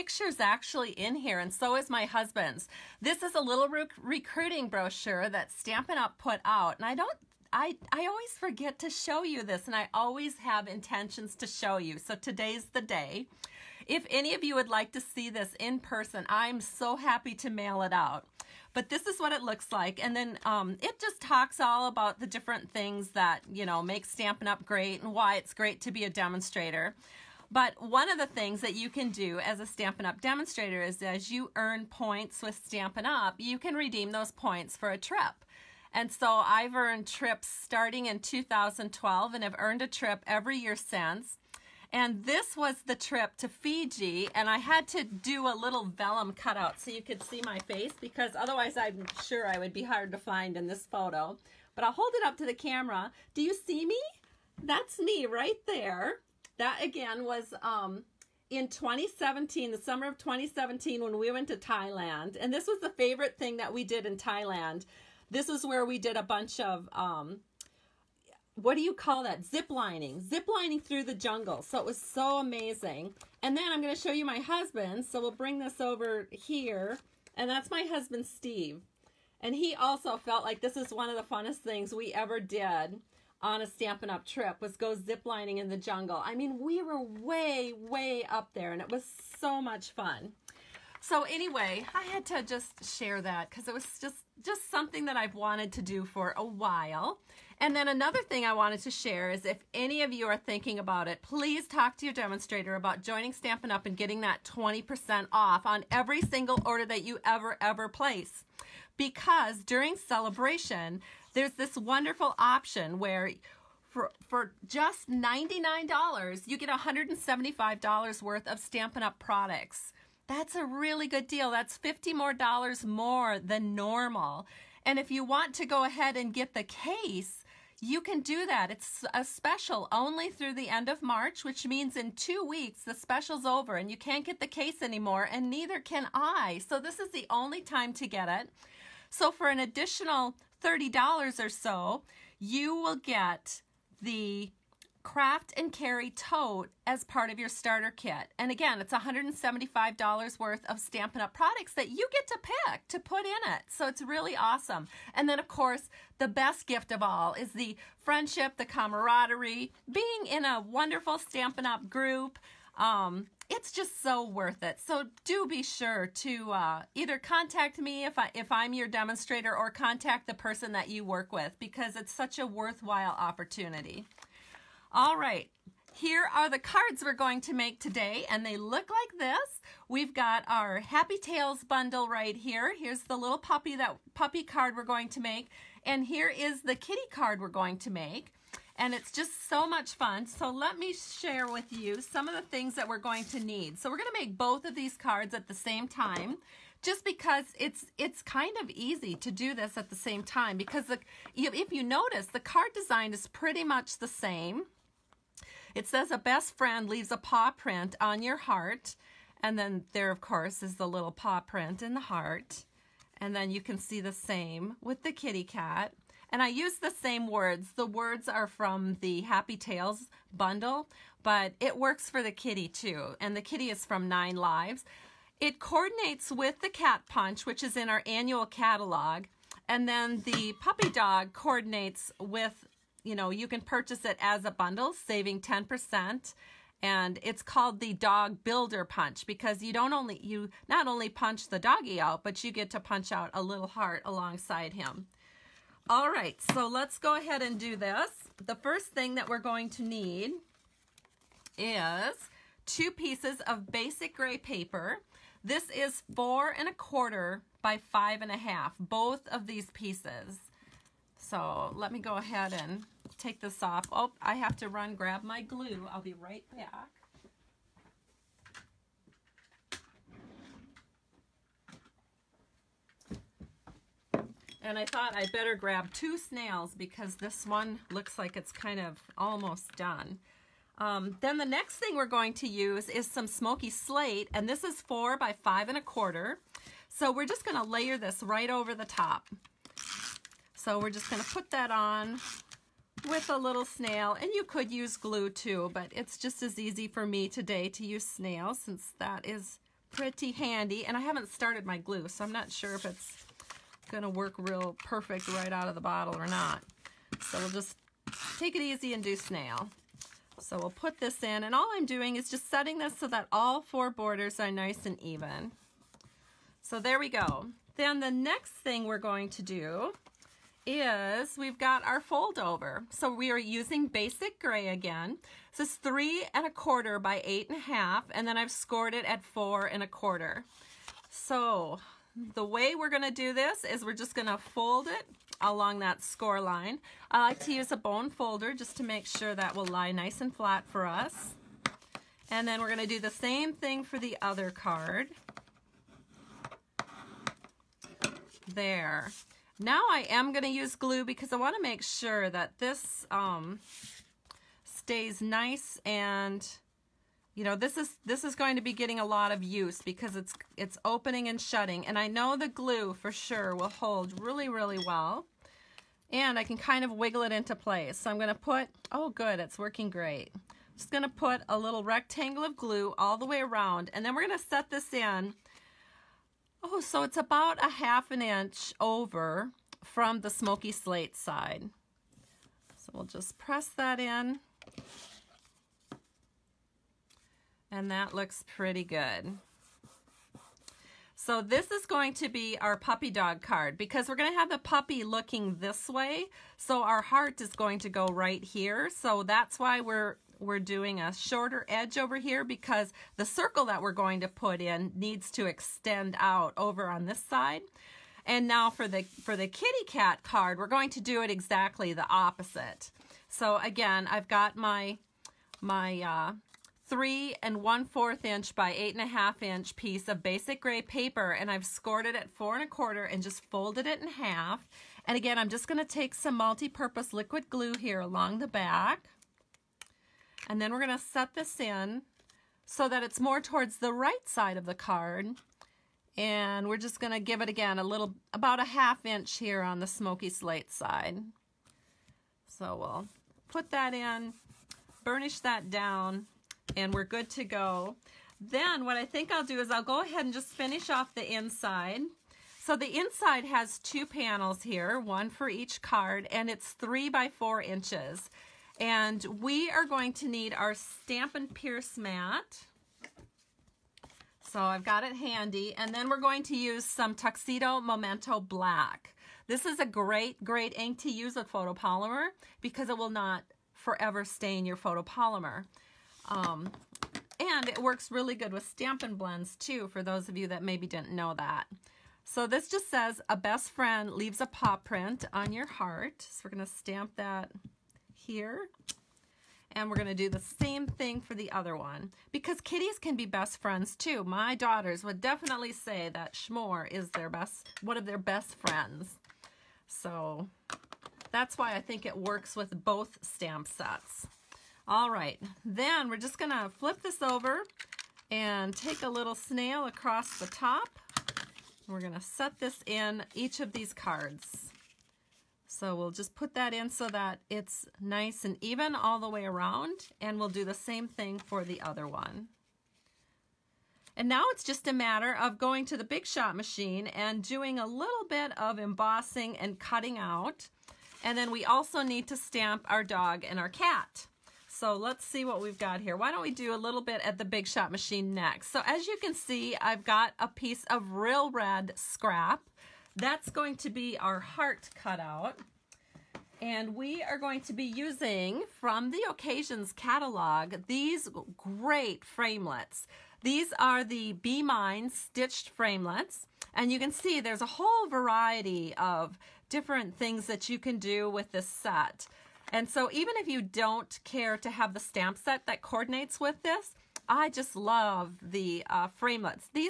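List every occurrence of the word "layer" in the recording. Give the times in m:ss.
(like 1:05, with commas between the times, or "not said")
4:47.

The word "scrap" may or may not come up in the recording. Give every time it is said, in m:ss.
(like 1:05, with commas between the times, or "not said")
9:01.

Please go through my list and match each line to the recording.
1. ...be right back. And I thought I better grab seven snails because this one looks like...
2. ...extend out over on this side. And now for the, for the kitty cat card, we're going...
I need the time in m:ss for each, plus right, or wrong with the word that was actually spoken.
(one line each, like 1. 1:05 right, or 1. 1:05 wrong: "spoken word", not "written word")
1. 4:25 wrong: "two", not "seven"
2. 6:45 right.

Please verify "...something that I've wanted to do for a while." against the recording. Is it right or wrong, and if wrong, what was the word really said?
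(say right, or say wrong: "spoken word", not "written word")
right.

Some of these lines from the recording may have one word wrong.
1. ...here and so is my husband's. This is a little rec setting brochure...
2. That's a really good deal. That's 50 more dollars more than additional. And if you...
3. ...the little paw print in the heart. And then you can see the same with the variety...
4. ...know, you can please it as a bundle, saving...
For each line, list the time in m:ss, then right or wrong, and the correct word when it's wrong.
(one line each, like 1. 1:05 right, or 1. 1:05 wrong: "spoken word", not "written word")
1. 0:01 wrong: "recruiting", not "setting"
2. 2:00 wrong: "normal", not "additional"
3. 3:30 wrong: "kitty", not "variety"
4. 3:53 wrong: "purchase", not "please".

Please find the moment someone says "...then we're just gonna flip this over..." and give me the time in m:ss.
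8:25.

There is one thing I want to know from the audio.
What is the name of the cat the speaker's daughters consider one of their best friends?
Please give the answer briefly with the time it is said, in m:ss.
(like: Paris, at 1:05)
Schmore, at 8:16.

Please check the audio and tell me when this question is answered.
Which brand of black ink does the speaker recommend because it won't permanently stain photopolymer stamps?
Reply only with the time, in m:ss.
7:47.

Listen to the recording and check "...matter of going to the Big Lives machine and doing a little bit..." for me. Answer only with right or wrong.
wrong.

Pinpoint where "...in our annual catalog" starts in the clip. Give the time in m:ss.
3:47.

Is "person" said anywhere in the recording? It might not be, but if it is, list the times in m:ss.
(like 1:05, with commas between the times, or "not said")
0:15, 2:50.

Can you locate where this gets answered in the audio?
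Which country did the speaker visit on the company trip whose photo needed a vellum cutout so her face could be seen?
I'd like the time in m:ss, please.
0:43.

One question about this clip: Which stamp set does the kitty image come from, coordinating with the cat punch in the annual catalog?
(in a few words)
Nine Lives.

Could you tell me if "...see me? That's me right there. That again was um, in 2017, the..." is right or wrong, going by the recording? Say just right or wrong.
right.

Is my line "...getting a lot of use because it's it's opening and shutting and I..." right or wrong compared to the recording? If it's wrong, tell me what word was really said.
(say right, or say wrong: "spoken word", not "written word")
right.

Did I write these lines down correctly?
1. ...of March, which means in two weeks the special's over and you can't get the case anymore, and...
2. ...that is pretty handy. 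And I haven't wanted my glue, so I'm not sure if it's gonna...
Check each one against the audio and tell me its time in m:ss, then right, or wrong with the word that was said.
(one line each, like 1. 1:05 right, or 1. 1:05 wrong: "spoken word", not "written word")
1. 2:10 right
2. 4:58 wrong: "started", not "wanted".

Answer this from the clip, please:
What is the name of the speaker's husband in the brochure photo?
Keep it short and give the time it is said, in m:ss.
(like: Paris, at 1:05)
Steve, at 1:18.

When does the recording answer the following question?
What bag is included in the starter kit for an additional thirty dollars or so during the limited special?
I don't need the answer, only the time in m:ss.
2:25.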